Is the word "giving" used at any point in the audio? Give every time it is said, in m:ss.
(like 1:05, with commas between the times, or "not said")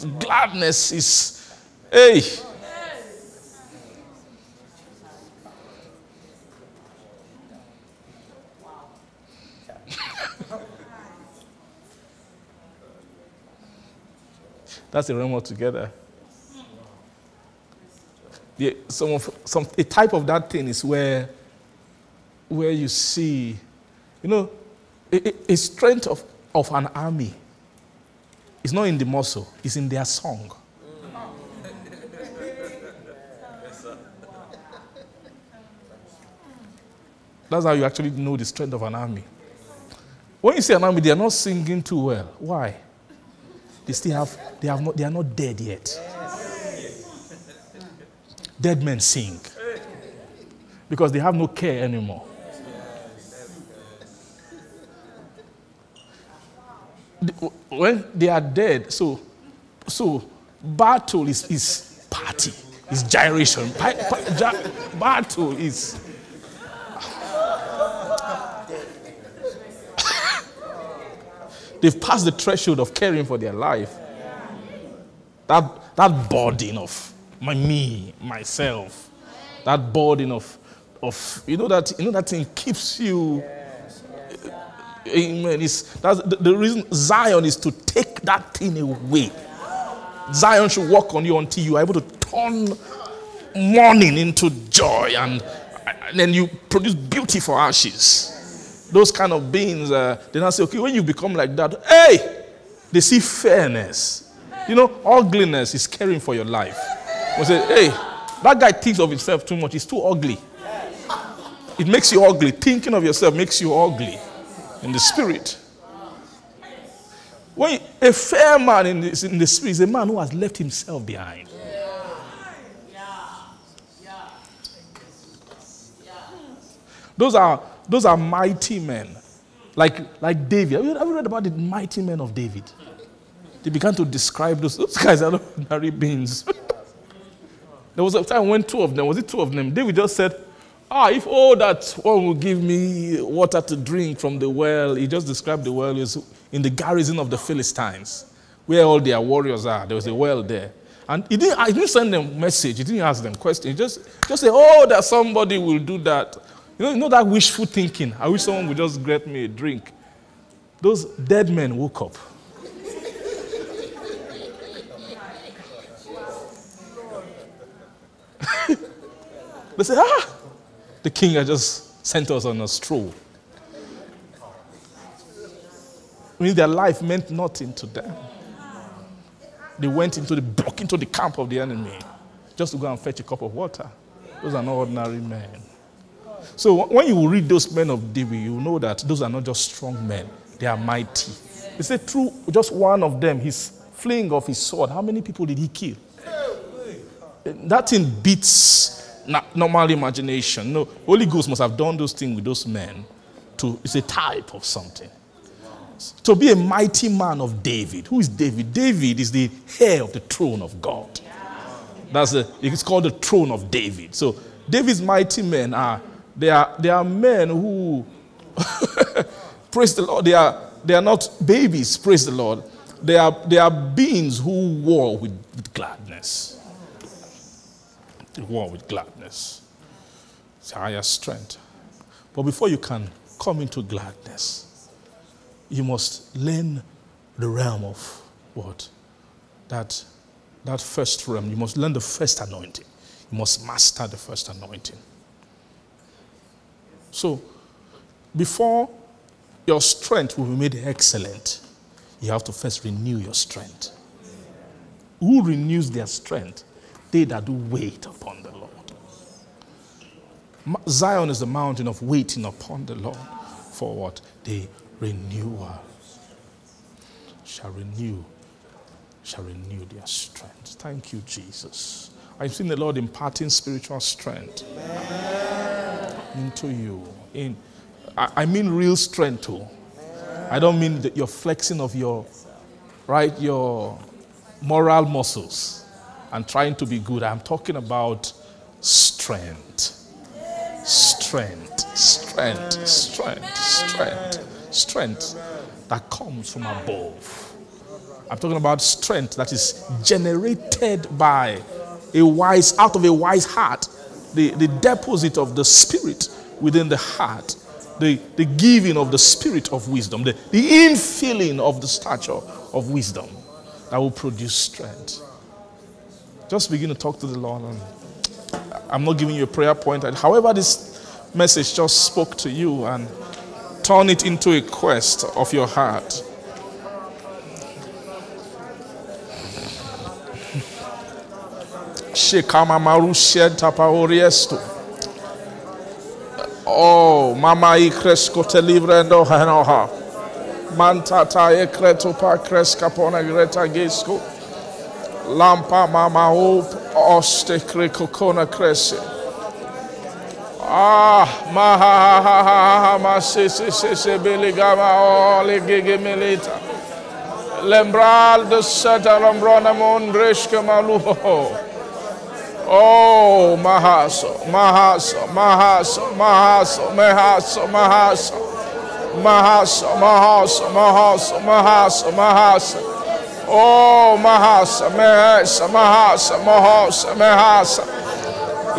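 5:08, 5:19.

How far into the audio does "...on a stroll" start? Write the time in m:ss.
2:52.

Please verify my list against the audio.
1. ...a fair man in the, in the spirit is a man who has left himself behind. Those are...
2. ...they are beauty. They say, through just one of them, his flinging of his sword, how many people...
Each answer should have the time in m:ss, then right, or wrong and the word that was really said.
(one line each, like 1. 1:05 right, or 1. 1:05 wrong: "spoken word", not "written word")
1. 1:58 right
2. 3:10 wrong: "mighty", not "beauty".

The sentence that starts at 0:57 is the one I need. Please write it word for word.
When they are dead, so, so battle is, is party, is gyration.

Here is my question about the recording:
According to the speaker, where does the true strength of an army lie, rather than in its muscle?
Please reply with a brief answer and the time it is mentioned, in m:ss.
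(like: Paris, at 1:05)
their song, at 0:29.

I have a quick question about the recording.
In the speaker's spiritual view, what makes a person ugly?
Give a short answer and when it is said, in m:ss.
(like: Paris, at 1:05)
caring for your life, at 1:45.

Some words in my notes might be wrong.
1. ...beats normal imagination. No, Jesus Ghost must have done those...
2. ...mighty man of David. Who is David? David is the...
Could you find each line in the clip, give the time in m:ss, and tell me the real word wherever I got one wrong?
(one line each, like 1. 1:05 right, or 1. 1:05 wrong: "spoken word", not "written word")
1. 3:18 wrong: "Holy", not "Jesus"
2. 3:26 right.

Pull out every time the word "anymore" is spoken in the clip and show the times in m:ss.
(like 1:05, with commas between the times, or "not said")
0:51.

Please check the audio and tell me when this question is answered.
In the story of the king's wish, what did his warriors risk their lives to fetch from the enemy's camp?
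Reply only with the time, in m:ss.
3:03.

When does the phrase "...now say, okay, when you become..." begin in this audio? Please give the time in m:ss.
1:40.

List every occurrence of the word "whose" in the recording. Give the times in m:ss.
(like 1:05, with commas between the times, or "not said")
not said.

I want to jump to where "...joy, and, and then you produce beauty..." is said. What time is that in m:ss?
1:34.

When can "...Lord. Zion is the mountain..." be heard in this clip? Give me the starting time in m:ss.
4:18.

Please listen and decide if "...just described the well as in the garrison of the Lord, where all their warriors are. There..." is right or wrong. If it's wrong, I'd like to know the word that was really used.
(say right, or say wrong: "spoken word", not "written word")
wrong: "Philistines", not "Lord".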